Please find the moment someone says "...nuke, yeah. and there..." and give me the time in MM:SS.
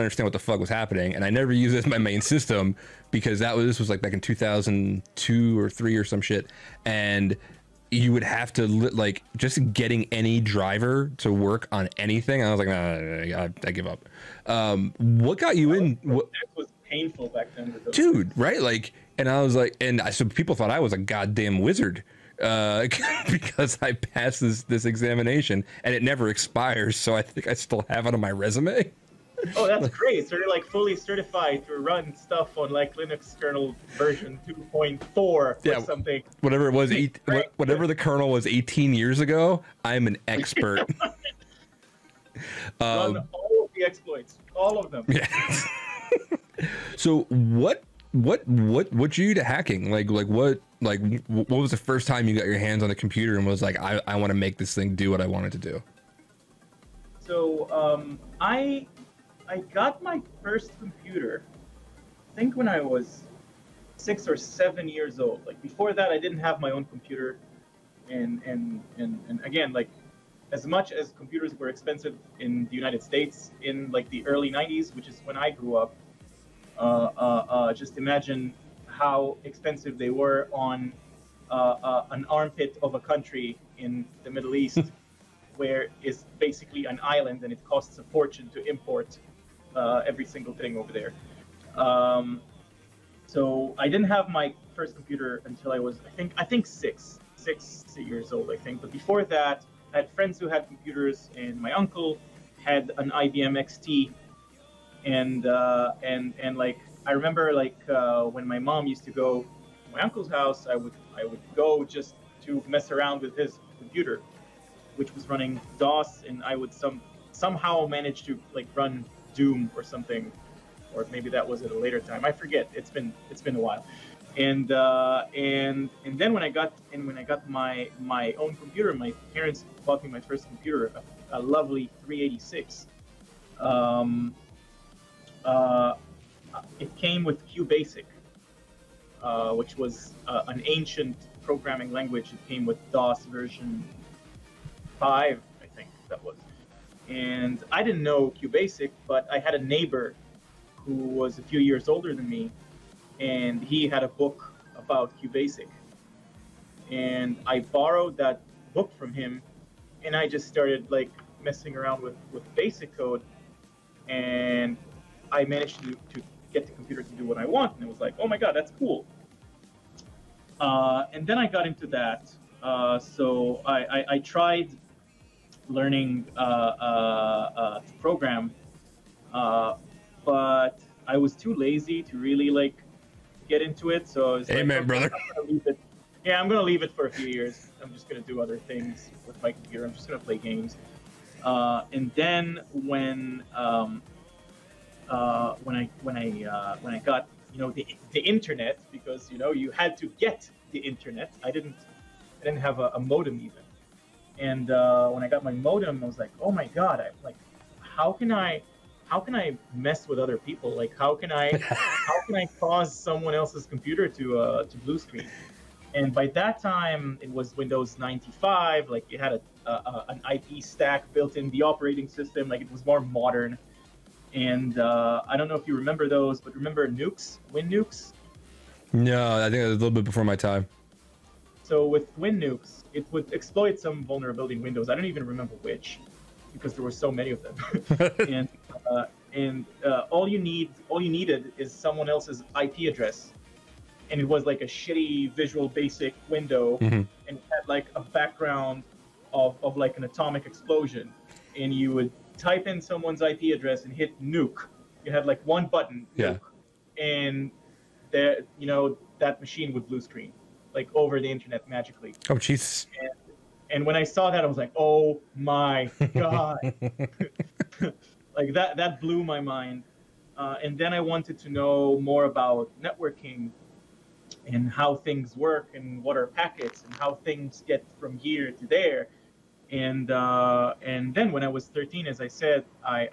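04:16.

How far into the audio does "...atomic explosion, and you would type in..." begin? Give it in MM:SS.
04:10.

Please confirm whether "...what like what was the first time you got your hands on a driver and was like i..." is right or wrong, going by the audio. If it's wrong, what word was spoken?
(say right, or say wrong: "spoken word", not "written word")
wrong: "computer", not "driver".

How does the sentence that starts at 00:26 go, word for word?
So I think I still have it on my resume.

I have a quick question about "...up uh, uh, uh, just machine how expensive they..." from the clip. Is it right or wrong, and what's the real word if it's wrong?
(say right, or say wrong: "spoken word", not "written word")
wrong: "imagine", not "machine".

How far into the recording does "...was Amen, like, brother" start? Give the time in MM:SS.
03:04.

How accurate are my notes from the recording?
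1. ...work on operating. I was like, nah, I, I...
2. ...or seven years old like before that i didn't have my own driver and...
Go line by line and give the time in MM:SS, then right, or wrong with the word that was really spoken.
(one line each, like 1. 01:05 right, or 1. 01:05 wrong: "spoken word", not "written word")
1. 00:11 wrong: "anything", not "operating"
2. 01:04 wrong: "computer", not "driver".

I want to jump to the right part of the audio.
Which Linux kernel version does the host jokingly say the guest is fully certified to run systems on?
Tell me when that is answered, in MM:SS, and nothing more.
00:34.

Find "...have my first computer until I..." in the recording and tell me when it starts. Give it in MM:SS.
01:34.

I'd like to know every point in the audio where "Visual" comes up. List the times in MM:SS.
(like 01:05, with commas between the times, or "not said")
04:05.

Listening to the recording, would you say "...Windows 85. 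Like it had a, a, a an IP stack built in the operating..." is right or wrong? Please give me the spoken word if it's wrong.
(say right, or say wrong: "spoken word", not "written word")
wrong: "95", not "85".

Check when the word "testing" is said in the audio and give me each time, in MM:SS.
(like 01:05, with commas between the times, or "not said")
not said.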